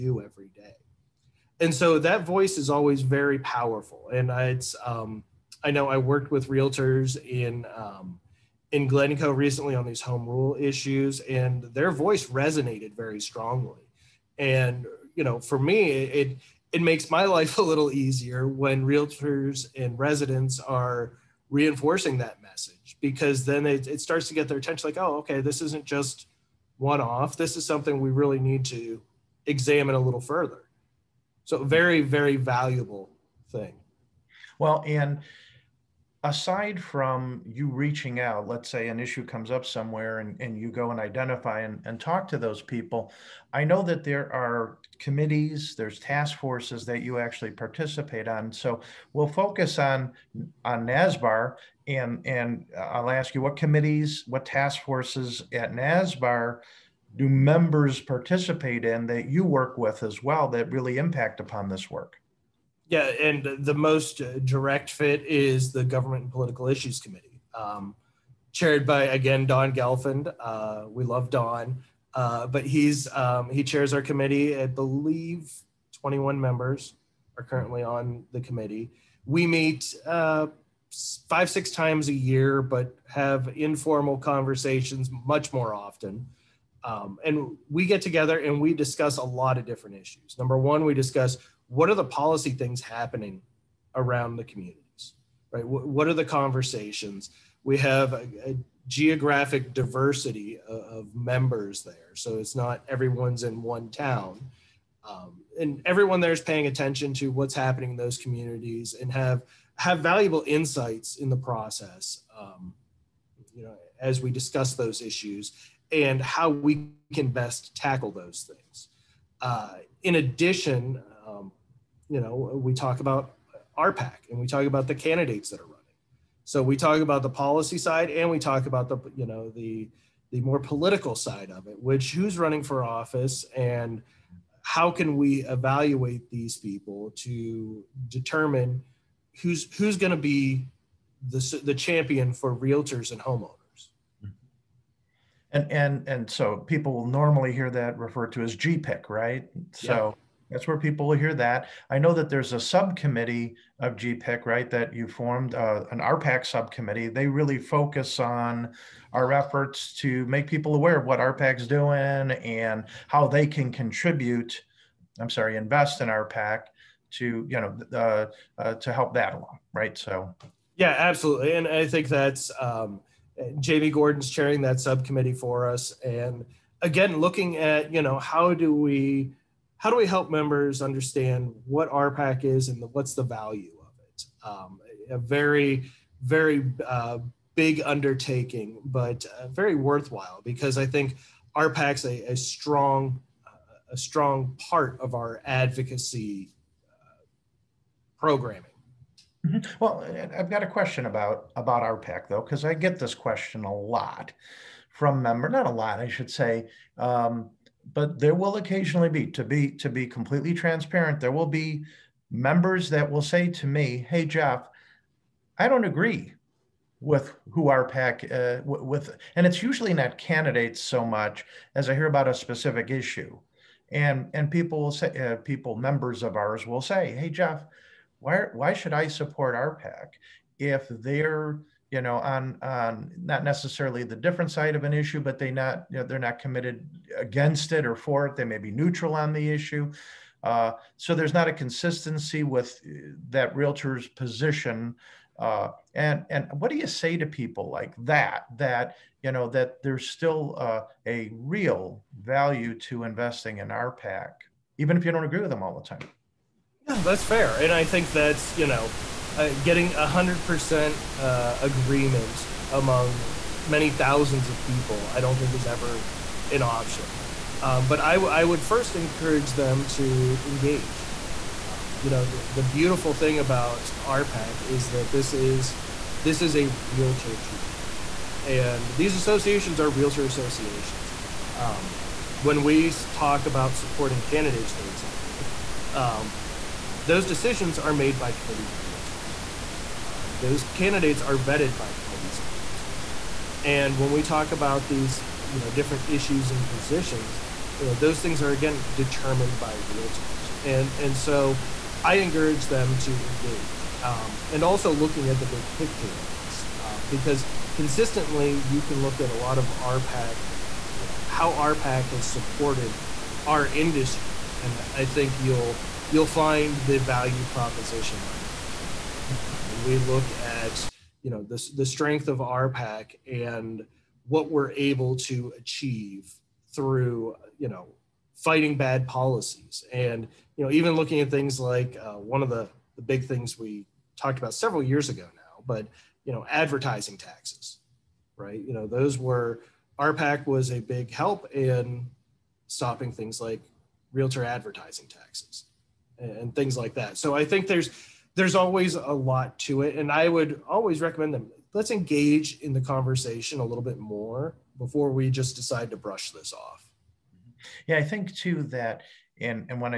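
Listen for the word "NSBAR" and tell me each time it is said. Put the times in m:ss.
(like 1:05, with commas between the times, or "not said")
0:50, 0:55.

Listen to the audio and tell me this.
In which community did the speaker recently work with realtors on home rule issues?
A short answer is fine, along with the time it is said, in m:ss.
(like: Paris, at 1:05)
Glencoe, at 0:08.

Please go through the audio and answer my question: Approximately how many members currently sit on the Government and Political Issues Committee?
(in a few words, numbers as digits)
21.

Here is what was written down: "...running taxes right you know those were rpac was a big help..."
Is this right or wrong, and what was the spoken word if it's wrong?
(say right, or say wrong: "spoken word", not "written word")
wrong: "advertising", not "running".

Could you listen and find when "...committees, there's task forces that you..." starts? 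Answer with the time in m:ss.
0:44.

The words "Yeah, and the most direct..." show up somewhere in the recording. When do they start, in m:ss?
1:02.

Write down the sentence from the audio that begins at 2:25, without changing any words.
And and and so people will normally hear that referred to as GPIC, right?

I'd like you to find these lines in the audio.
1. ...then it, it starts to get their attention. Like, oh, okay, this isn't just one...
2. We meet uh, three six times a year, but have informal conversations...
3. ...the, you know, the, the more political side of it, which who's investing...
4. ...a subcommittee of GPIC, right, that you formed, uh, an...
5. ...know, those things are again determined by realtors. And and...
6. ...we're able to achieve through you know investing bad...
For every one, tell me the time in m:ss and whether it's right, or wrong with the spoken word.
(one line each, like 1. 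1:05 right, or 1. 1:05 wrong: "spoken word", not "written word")
1. 0:23 right
2. 1:19 wrong: "five", not "three"
3. 2:08 wrong: "running", not "investing"
4. 2:32 right
5. 4:57 right
6. 5:24 wrong: "fighting", not "investing".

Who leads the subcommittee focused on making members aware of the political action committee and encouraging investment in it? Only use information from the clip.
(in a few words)
Jamie Gordon.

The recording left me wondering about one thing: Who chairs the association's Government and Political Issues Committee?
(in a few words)
Don Gelfand.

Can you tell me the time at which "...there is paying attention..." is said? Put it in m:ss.
1:46.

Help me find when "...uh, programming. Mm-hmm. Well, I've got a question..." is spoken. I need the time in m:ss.
3:16.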